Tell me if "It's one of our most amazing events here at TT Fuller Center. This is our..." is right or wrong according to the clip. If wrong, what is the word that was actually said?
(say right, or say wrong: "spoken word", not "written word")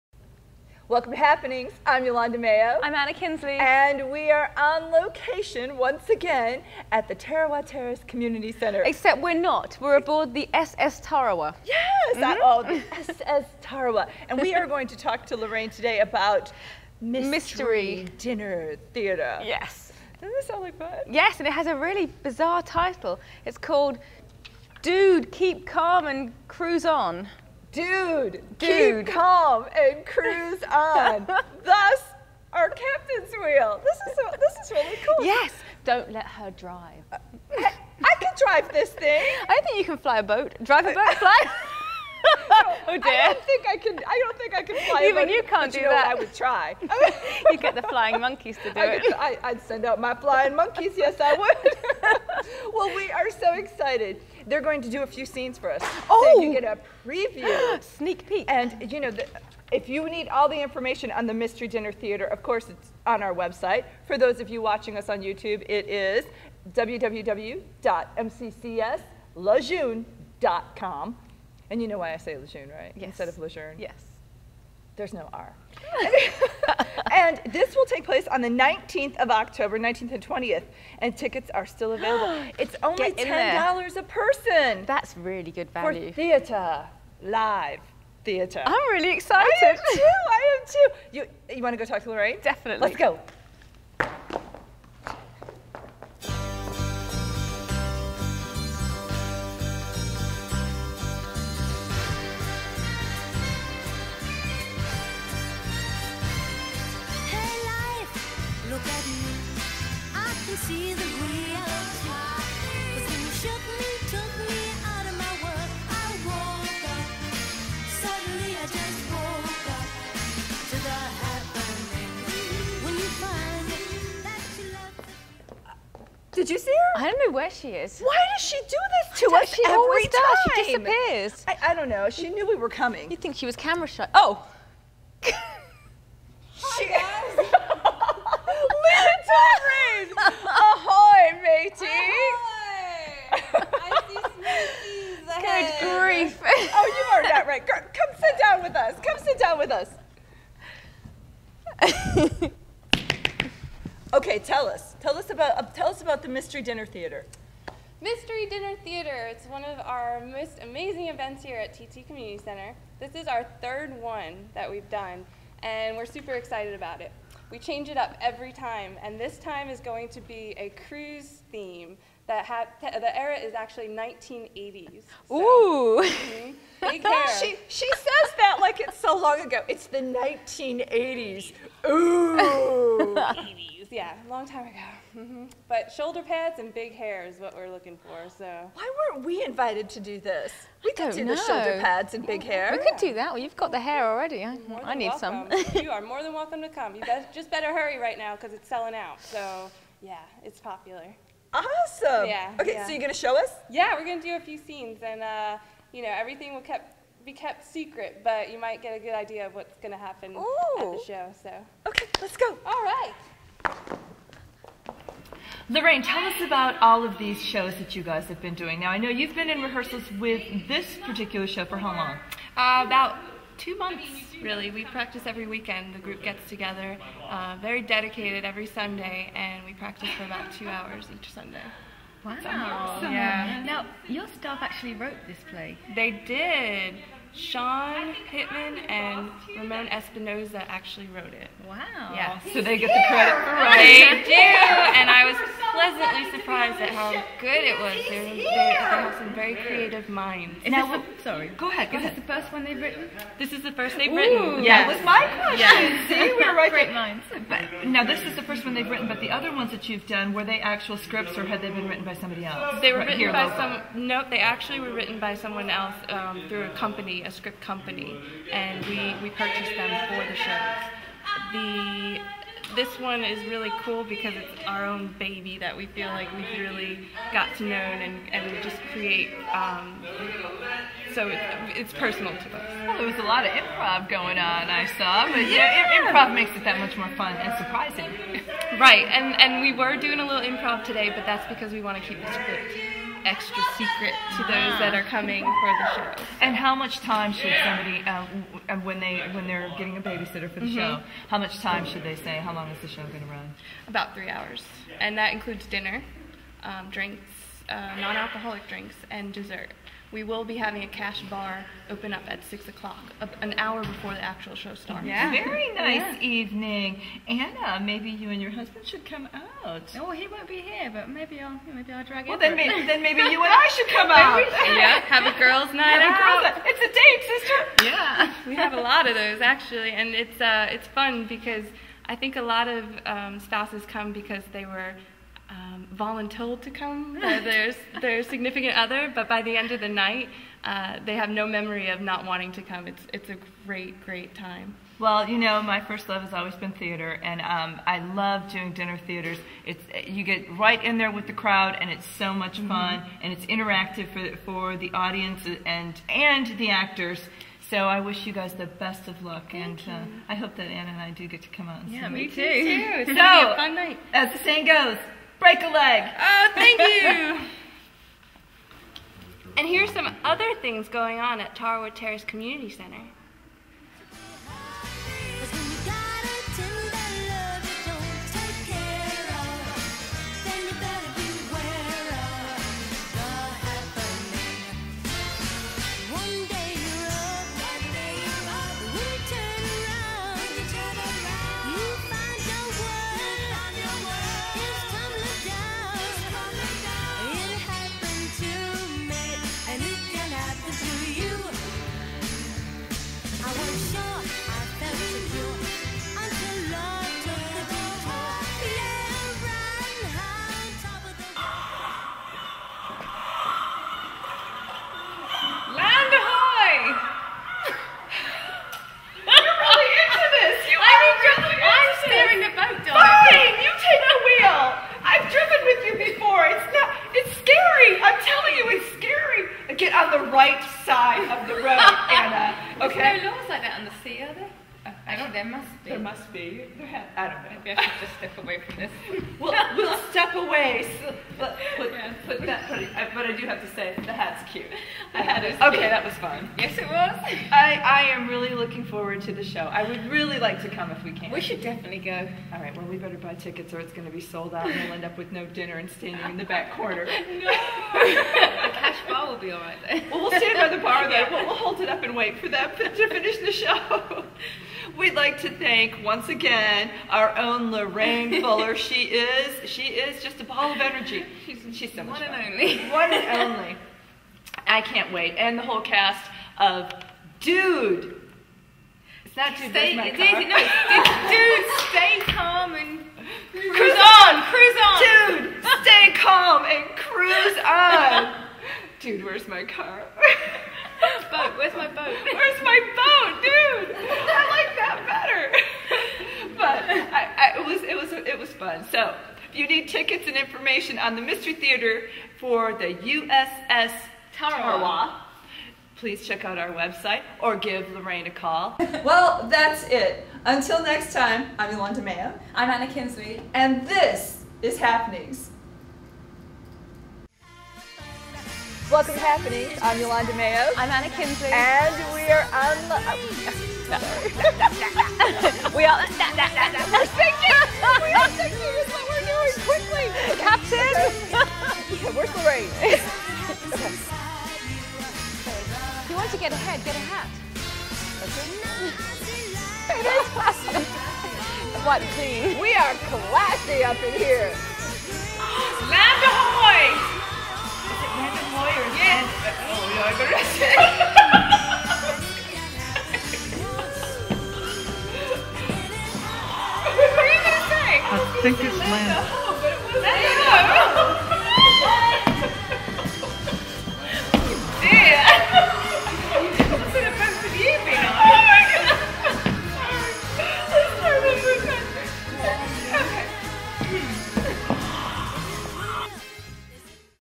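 wrong: "Community", not "Fuller".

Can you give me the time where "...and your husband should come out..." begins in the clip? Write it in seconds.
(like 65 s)
318 s.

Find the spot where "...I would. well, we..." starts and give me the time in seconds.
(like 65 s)
51 s.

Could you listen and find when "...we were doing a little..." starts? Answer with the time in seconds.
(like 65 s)
289 s.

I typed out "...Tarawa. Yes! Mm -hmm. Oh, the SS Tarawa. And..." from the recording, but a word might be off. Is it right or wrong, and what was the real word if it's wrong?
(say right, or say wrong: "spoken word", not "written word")
right.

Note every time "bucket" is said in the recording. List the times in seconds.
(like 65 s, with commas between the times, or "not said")
not said.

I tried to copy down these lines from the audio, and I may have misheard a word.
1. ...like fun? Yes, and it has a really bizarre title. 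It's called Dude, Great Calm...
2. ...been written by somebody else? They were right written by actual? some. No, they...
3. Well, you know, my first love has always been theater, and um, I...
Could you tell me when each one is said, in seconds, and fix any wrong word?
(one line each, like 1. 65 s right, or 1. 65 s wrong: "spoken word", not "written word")
1. 20 s wrong: "Keep", not "Great"
2. 261 s wrong: "local", not "actual"
3. 344 s right.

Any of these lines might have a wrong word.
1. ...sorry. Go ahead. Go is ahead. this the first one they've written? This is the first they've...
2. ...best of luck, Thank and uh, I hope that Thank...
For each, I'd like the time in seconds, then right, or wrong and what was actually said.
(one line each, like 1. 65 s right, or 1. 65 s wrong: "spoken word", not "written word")
1. 251 s right
2. 358 s wrong: "Anna", not "Thank".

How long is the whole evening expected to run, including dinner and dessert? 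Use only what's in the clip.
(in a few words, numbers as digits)
about three hours.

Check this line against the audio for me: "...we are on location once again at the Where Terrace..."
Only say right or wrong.
wrong.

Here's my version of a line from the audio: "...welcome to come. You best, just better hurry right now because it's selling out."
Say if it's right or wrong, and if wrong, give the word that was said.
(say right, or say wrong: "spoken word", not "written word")
right.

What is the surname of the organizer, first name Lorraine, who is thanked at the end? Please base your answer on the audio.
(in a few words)
Fuller.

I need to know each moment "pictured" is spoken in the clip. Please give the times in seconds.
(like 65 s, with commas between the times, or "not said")
not said.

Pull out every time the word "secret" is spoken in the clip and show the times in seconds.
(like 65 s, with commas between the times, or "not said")
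207 s, 293 s.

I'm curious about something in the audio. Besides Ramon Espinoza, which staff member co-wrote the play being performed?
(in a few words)
Sean Pittman.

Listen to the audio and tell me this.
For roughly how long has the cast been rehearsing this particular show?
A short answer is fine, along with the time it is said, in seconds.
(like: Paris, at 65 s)
about two months, at 222 s.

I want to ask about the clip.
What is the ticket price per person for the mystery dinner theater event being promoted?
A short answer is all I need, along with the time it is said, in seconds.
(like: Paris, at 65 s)
$10, at 83 s.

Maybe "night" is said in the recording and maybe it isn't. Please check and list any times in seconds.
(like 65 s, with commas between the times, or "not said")
325 s, 339 s, 363 s.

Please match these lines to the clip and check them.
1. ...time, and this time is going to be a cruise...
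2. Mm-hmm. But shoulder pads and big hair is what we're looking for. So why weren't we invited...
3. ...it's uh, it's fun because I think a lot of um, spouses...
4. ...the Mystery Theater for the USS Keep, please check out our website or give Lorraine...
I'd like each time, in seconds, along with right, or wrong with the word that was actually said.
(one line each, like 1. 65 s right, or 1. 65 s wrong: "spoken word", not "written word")
1. 168 s right
2. 185 s right
3. 330 s right
4. 501 s wrong: "Tarawa", not "Keep".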